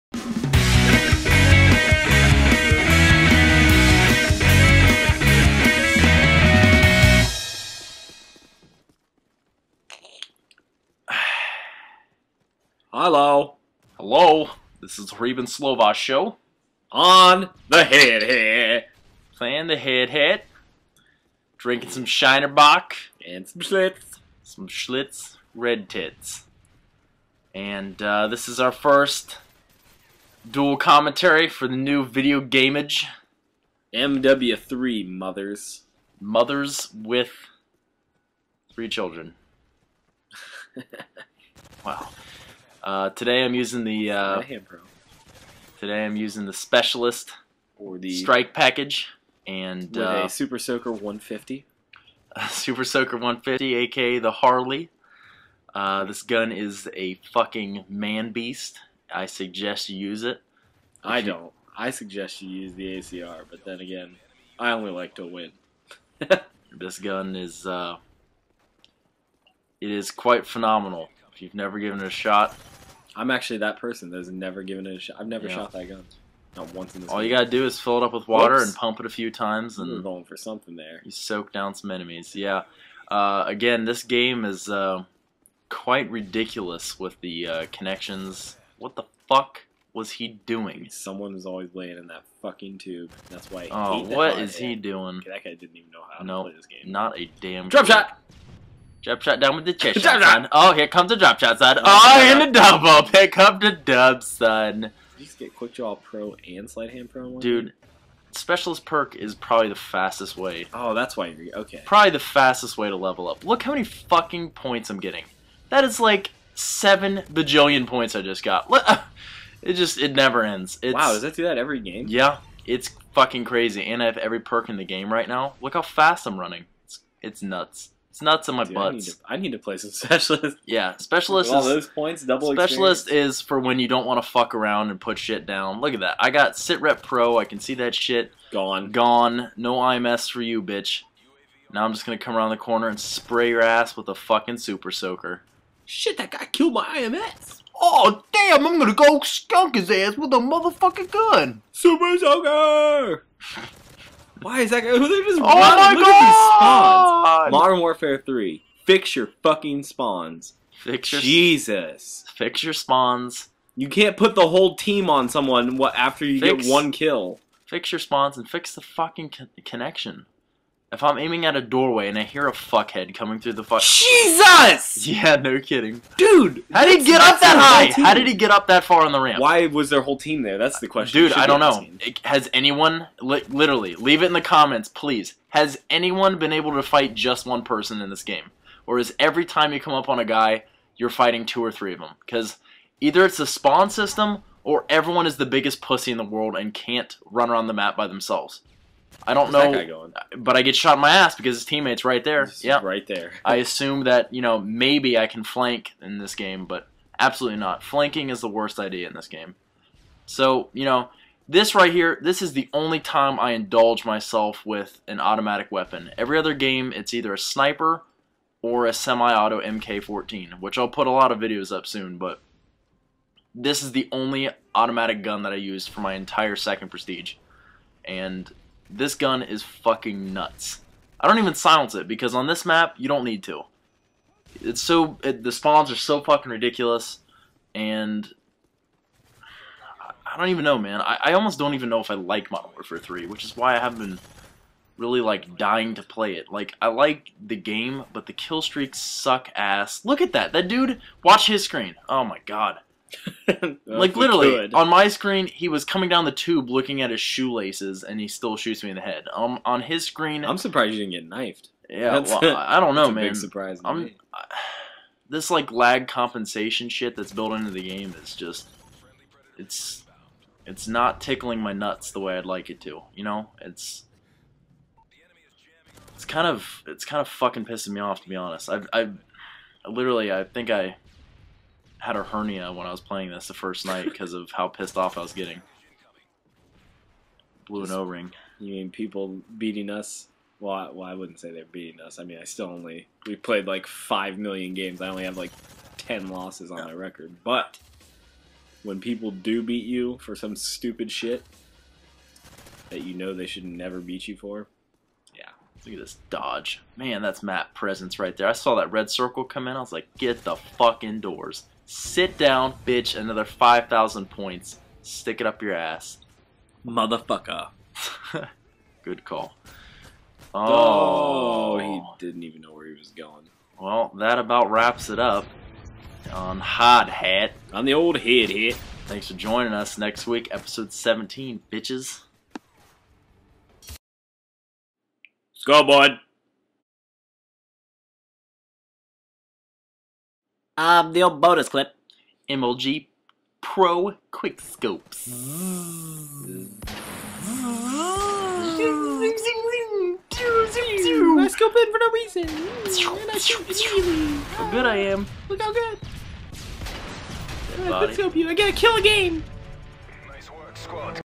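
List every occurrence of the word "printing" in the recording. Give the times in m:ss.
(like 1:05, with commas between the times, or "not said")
not said.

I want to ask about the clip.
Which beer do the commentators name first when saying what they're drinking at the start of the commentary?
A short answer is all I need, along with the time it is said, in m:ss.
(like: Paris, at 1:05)
Shiner Bock, at 0:22.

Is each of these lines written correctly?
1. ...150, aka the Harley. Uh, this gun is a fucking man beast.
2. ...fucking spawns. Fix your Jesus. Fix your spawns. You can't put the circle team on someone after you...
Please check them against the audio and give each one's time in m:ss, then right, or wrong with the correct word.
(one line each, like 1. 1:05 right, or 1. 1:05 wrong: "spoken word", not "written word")
1. 0:53 right
2. 2:39 wrong: "whole", not "circle".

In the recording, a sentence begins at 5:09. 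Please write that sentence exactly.
I was like, get the fuck indoors.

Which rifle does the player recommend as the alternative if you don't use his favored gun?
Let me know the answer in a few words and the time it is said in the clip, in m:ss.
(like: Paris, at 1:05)
ACR, at 1:02.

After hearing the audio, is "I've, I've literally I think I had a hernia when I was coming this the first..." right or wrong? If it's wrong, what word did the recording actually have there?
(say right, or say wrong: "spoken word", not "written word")
wrong: "playing", not "coming".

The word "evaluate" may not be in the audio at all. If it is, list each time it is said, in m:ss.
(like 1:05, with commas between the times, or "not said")
not said.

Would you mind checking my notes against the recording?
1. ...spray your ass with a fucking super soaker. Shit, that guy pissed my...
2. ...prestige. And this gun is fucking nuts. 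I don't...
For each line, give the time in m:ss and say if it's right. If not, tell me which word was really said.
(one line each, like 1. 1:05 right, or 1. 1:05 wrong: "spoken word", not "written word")
1. 2:22 wrong: "killed", not "pissed"
2. 3:46 right.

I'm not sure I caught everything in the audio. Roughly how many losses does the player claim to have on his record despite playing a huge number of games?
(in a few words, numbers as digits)
10.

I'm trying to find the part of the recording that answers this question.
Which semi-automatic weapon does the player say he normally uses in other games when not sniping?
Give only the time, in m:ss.
3:39.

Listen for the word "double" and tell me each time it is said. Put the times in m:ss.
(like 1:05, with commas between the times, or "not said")
1:42, 2:12.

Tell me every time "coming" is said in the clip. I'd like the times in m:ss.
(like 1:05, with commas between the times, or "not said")
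2:53, 4:15.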